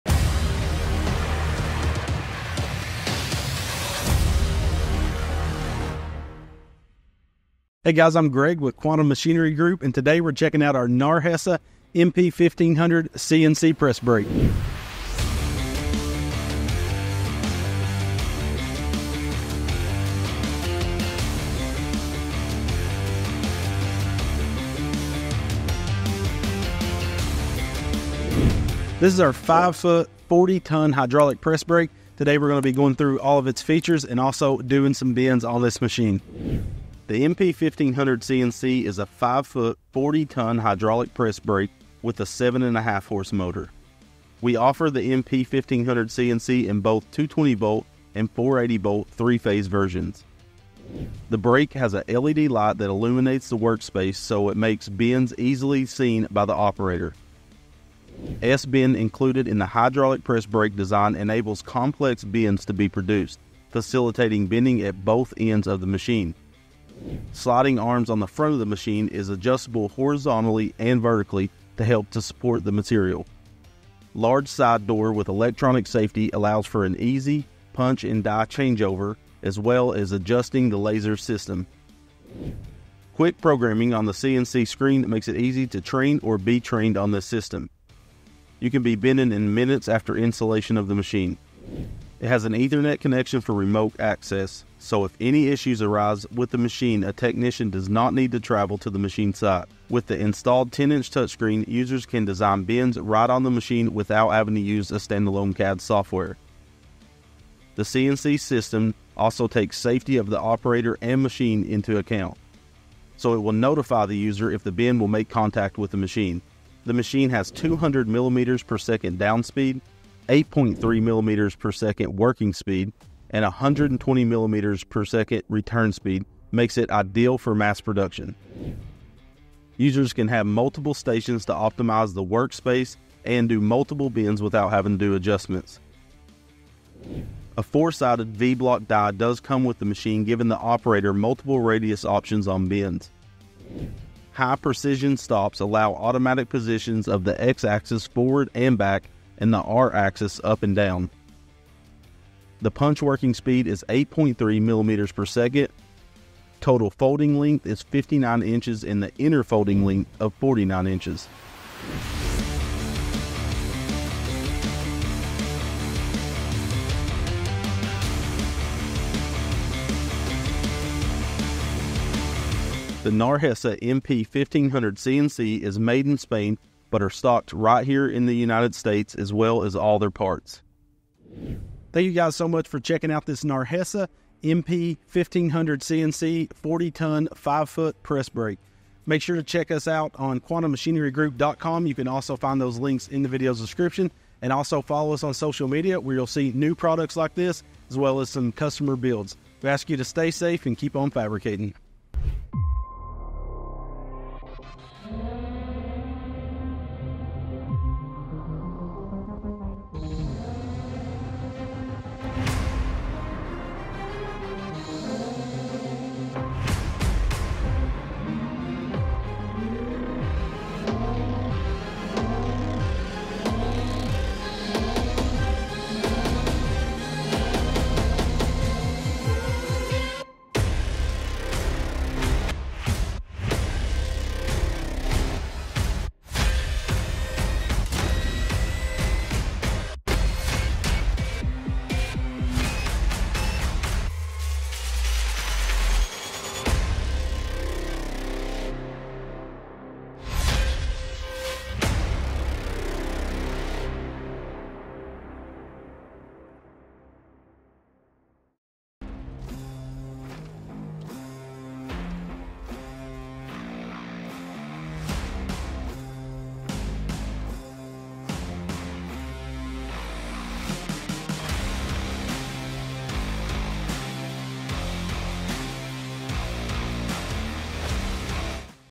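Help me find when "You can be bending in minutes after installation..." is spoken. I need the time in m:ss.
1:28.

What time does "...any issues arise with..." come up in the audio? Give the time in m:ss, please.
1:35.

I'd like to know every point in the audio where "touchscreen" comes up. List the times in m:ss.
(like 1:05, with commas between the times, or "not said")
1:41.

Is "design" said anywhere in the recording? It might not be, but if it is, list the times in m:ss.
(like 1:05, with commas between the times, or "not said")
1:00, 1:42.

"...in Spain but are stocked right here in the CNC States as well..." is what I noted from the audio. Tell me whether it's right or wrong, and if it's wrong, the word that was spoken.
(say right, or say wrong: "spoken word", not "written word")
wrong: "United", not "CNC".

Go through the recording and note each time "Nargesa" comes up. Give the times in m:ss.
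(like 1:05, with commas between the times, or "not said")
0:10, 2:53, 3:03.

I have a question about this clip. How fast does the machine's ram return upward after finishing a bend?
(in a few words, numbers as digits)
120 mm per second.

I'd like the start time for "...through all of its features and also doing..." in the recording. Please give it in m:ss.
0:32.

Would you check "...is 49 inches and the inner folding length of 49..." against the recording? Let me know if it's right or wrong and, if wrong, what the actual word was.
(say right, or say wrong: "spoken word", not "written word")
wrong: "59", not "49".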